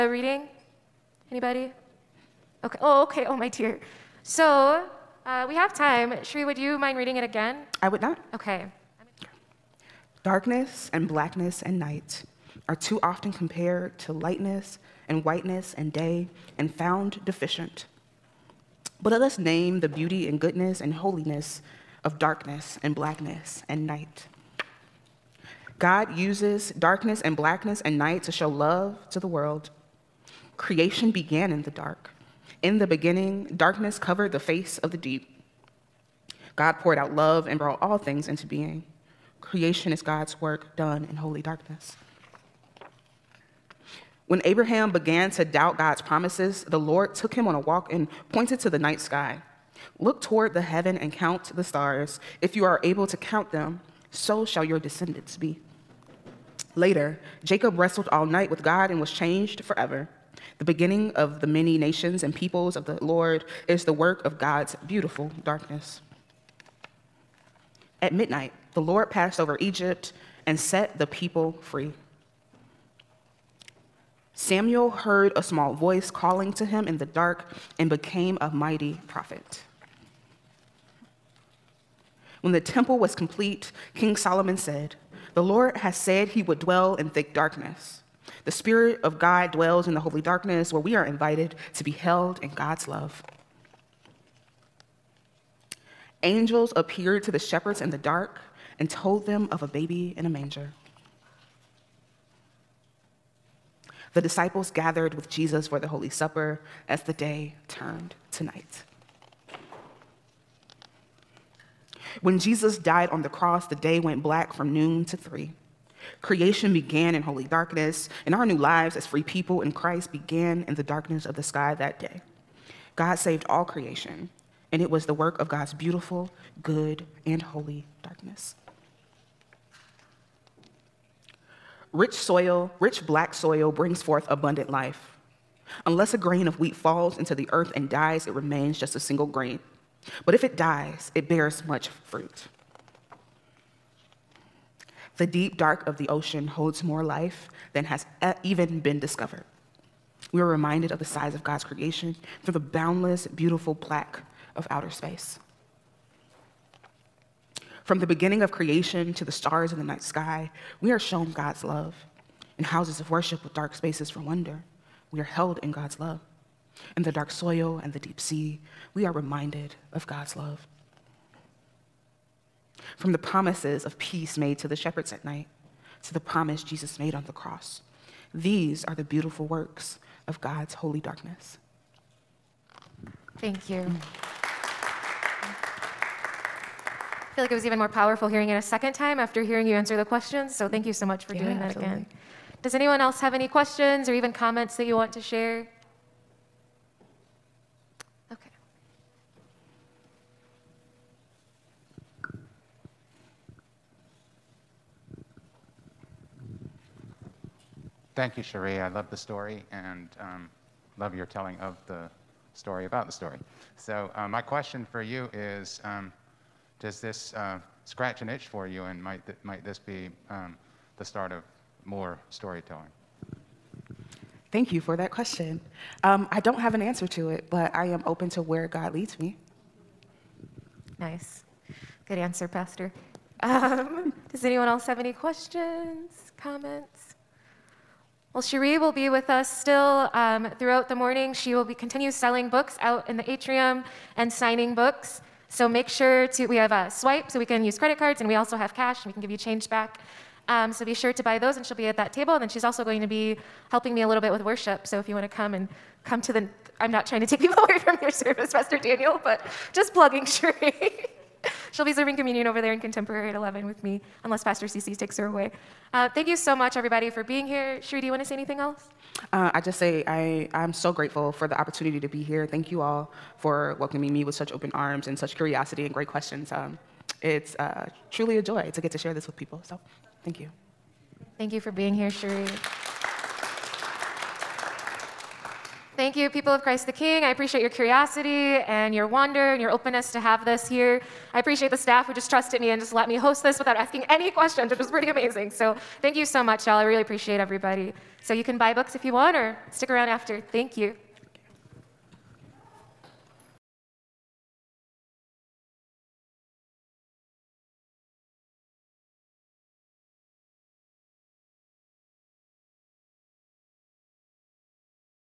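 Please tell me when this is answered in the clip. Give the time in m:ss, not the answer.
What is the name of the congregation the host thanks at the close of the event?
4:46.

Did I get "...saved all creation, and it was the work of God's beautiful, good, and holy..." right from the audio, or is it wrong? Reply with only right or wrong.
right.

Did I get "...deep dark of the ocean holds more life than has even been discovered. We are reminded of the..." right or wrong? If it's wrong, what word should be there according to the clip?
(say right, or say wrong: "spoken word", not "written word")
right.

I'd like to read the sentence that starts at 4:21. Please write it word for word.
She'll be serving communion over there in contemporary at 11 with me, unless Pastor CC takes her away.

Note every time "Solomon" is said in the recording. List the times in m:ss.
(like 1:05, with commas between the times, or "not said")
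1:24.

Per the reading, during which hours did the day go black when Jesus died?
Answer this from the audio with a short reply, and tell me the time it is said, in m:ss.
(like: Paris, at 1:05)
noon to three, at 1:54.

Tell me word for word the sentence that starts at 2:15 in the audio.
Unless a grain of wheat falls into the earth and dies, it remains just a single grain.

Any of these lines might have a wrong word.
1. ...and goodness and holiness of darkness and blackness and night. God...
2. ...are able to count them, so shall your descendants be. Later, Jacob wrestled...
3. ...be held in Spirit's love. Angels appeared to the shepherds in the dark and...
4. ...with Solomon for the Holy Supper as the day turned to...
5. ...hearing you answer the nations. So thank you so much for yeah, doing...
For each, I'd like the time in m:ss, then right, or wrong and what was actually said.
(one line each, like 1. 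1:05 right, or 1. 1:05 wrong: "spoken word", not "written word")
1. 0:20 right
2. 0:52 right
3. 1:31 wrong: "God", not "Spirit"
4. 1:45 wrong: "Jesus", not "Solomon"
5. 3:09 wrong: "questions", not "nations".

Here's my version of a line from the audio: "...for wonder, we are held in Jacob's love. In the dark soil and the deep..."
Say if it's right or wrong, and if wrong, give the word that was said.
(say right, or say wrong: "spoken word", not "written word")
wrong: "God", not "Jacob".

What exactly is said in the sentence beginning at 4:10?
Um, so be sure to buy those, and she'll be at that table.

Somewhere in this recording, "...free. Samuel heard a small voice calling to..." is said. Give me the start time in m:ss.
1:11.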